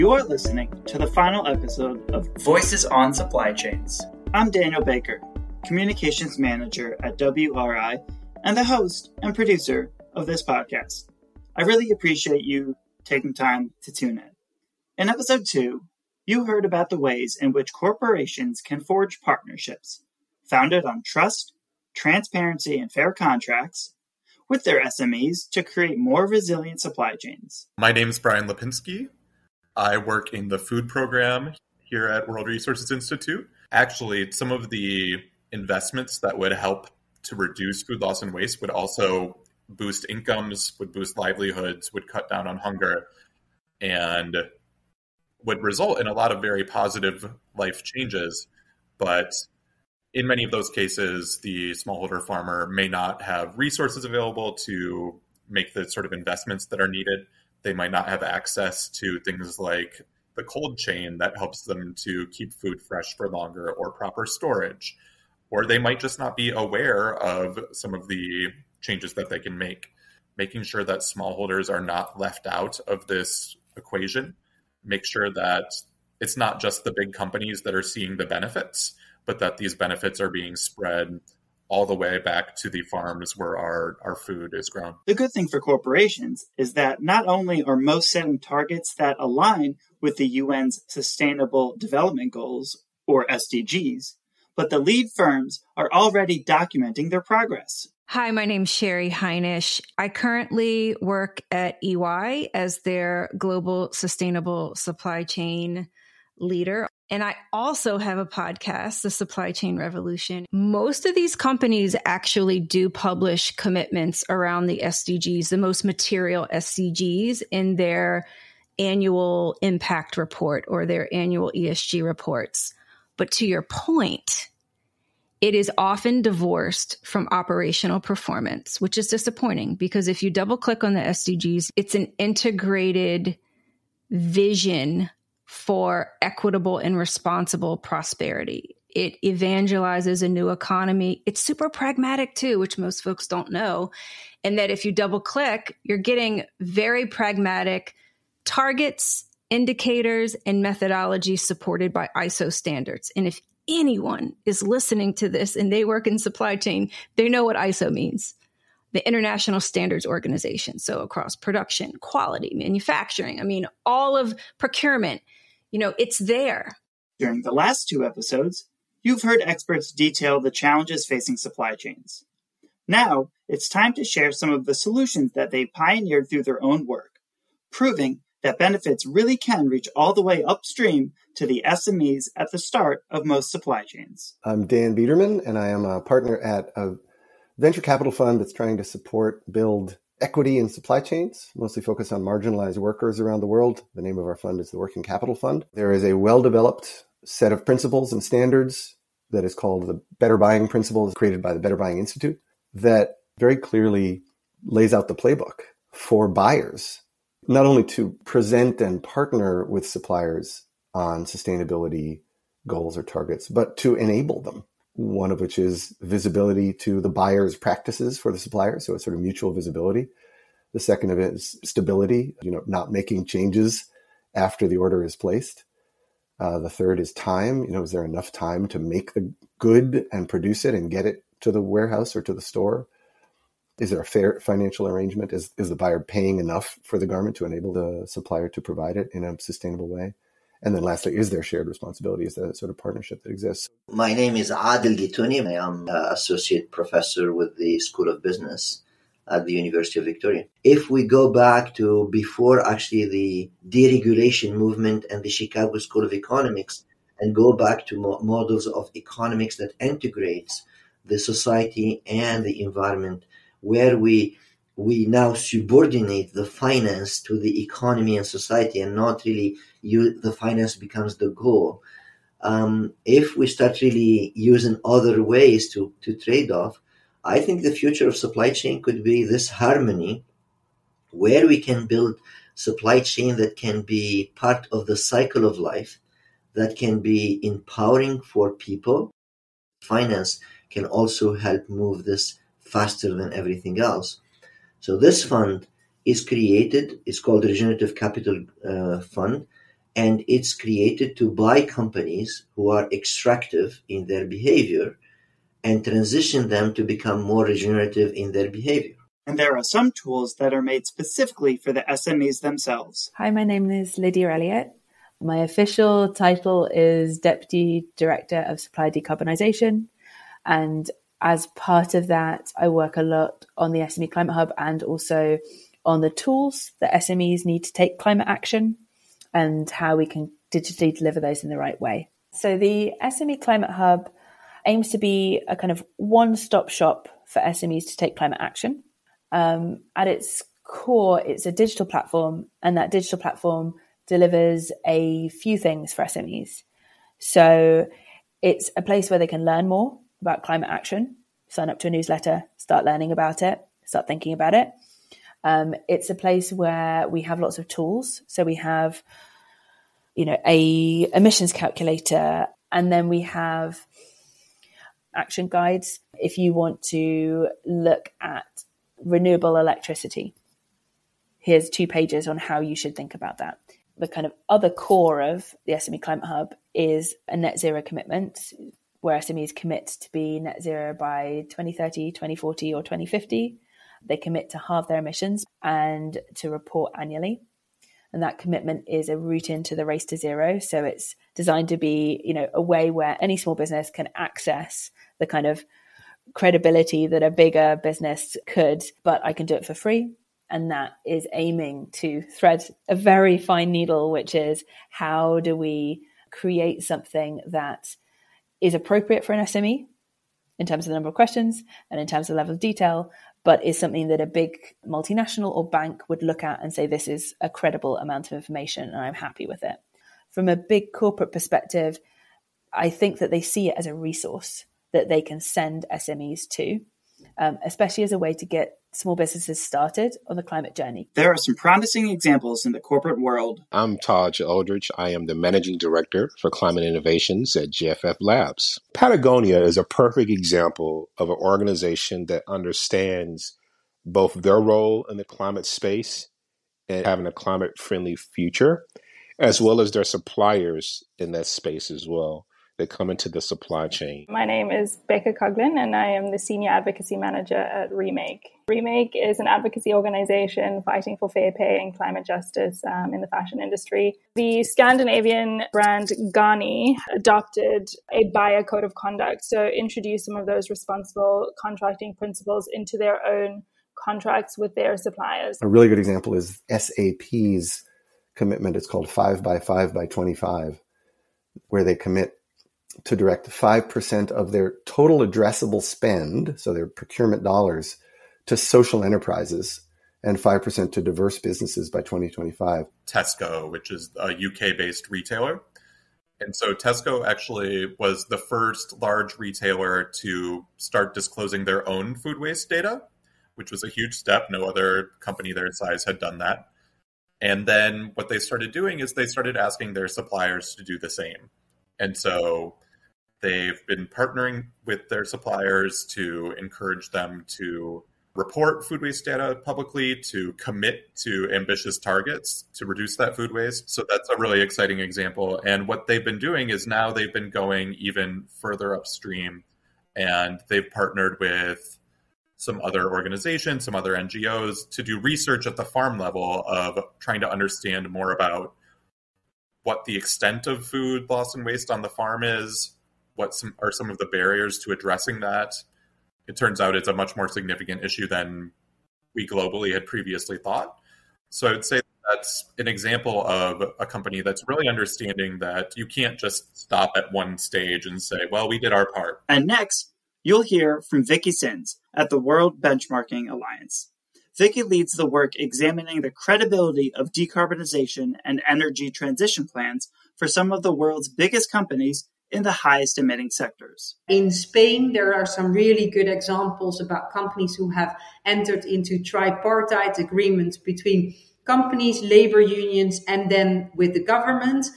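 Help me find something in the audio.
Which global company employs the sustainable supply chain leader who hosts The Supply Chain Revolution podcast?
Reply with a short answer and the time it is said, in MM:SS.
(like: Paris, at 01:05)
EY, at 01:41.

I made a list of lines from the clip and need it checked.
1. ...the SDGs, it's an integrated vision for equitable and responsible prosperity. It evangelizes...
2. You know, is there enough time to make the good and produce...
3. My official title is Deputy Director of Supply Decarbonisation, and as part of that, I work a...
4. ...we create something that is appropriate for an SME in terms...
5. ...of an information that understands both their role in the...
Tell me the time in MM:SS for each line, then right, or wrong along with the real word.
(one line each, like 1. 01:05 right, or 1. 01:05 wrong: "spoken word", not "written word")
1. 02:10 right
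2. 03:47 right
3. 05:15 right
4. 06:45 right
5. 07:21 wrong: "organization", not "information".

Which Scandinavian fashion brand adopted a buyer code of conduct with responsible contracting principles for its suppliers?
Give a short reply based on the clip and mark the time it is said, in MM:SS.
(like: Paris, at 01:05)
Ganni, at 07:46.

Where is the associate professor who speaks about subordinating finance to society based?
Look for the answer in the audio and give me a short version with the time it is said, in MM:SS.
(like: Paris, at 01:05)
University of Victoria, at 04:09.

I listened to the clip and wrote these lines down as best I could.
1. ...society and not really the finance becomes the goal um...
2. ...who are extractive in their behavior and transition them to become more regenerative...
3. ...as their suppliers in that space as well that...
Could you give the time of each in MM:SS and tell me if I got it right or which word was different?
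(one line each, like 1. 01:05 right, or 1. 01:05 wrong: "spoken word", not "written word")
1. 04:28 right
2. 05:02 right
3. 07:29 right.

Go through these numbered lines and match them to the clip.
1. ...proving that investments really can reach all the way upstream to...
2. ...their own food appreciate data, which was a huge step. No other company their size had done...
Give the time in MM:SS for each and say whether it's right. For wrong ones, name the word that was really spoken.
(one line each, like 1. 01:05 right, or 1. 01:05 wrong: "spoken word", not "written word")
1. 02:57 wrong: "benefits", not "investments"
2. 08:21 wrong: "waste", not "appreciate".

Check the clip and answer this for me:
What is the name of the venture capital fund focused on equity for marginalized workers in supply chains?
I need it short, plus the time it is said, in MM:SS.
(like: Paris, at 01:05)
Working Capital Fund, at 03:14.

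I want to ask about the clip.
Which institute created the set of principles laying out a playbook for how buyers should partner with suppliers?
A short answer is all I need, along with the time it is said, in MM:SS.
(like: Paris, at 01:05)
Better Buying Institute, at 03:21.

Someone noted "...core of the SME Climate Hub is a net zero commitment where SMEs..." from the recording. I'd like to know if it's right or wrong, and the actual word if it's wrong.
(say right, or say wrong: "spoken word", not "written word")
right.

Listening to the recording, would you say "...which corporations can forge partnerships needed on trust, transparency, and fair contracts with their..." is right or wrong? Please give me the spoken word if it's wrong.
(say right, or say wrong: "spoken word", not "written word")
wrong: "founded", not "needed".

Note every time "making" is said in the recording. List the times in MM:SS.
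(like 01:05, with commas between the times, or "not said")
01:10, 03:42.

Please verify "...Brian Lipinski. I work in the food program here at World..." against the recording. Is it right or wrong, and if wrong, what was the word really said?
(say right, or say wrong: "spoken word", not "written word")
right.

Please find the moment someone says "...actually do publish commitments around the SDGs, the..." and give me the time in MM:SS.
01:52.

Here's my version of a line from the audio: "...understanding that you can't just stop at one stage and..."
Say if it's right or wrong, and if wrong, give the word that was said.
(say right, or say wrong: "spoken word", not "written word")
right.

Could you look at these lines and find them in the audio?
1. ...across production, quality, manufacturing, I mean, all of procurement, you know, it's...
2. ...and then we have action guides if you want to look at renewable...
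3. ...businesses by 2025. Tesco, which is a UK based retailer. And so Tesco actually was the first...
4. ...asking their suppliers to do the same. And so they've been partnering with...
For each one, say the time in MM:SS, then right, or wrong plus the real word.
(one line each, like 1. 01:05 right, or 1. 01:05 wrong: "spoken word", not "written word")
1. 02:40 right
2. 06:02 right
3. 08:11 right
4. 08:29 right.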